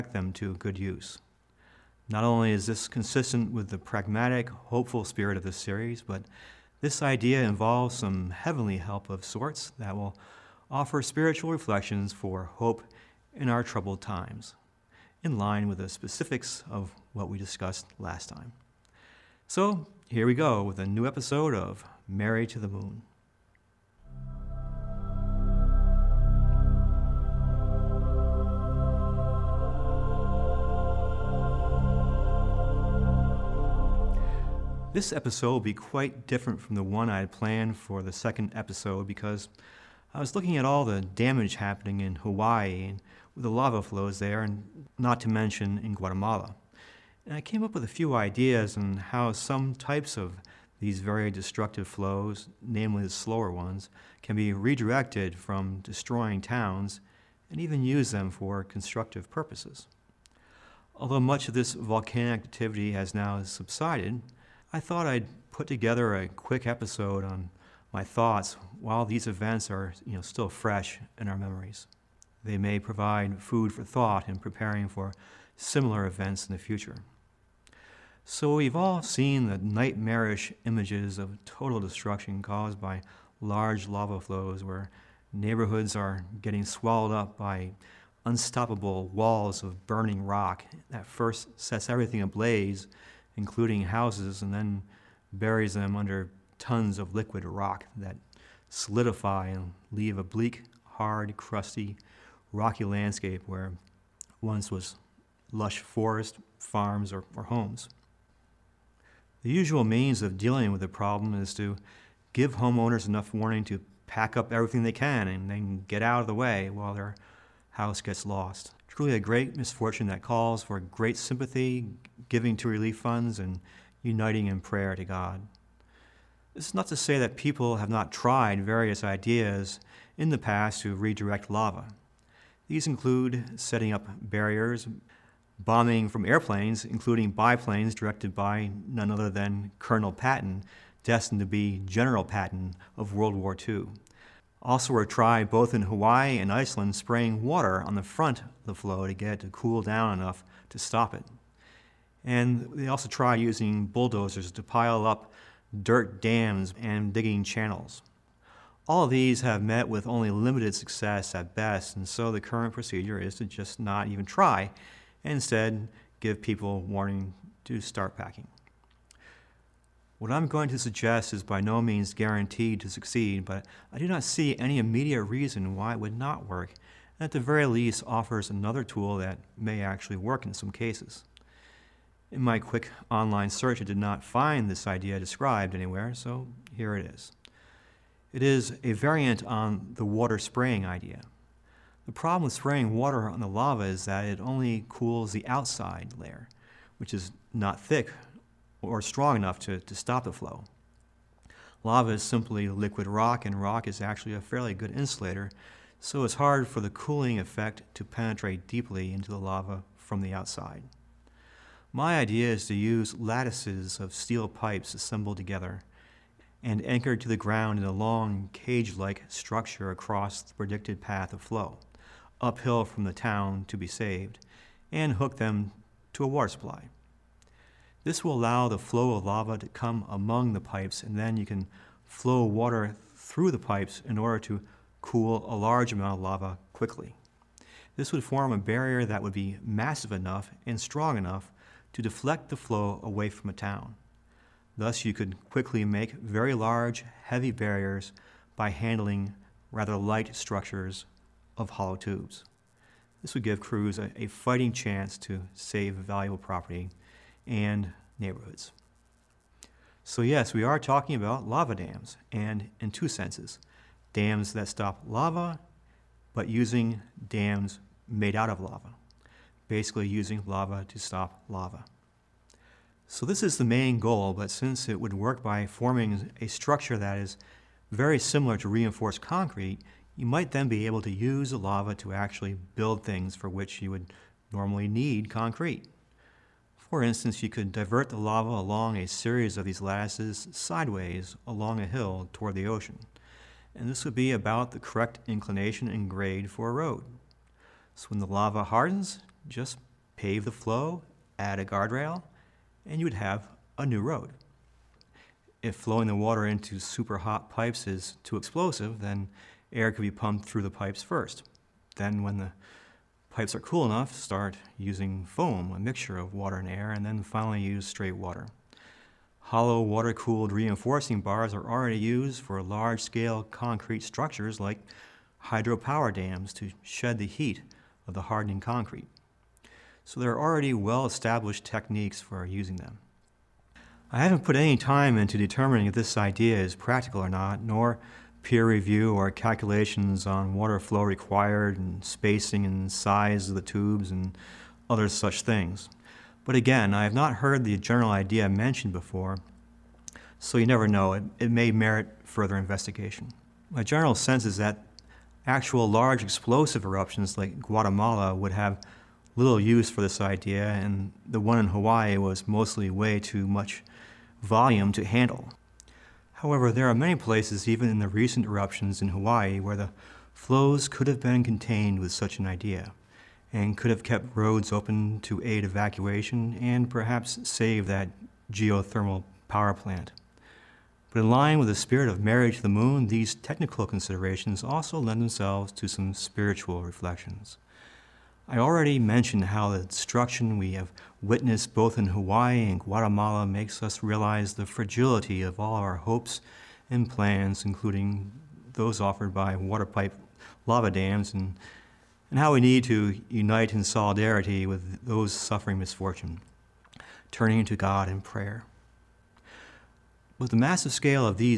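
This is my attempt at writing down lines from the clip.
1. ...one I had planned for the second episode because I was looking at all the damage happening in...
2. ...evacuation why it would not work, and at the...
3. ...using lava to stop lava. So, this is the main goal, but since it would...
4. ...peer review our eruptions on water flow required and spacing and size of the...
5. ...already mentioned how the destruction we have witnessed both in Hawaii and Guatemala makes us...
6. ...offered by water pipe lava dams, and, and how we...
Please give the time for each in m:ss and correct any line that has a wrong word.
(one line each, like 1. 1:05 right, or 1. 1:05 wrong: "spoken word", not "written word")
1. 0:36 right
2. 2:55 wrong: "reason", not "evacuation"
3. 4:30 right
4. 5:38 wrong: "calculations", not "eruptions"
5. 6:28 right
6. 6:38 right.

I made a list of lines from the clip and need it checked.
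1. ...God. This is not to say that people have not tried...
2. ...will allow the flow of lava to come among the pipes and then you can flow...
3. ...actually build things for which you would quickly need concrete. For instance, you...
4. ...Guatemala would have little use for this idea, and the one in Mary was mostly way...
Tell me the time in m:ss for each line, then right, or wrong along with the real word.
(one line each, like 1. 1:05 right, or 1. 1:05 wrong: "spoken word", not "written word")
1. 2:05 right
2. 3:48 right
3. 4:42 wrong: "normally", not "quickly"
4. 5:57 wrong: "Hawaii", not "Mary".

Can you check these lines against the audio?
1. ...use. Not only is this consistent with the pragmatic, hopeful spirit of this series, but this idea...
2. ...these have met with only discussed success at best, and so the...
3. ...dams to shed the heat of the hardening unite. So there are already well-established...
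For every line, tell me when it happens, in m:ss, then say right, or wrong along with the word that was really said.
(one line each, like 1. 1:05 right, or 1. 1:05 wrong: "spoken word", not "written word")
1. 0:00 right
2. 2:39 wrong: "limited", not "discussed"
3. 5:26 wrong: "concrete", not "unite".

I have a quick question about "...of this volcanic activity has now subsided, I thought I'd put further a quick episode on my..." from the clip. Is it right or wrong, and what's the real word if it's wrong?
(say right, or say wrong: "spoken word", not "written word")
wrong: "together", not "further".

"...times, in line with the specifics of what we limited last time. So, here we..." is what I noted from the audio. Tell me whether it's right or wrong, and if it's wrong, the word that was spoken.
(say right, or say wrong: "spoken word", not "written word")
wrong: "discussed", not "limited".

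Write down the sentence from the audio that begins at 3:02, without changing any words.
In my quick online search, I did not find this idea described anywhere, so here it is.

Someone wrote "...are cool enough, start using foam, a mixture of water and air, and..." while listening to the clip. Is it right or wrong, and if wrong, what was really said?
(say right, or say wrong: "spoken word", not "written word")
right.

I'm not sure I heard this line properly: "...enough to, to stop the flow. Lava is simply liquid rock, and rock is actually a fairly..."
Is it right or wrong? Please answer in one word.
right.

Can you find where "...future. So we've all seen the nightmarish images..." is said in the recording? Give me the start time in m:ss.
1:16.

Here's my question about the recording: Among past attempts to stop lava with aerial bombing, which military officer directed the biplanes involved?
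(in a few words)
Colonel Patton.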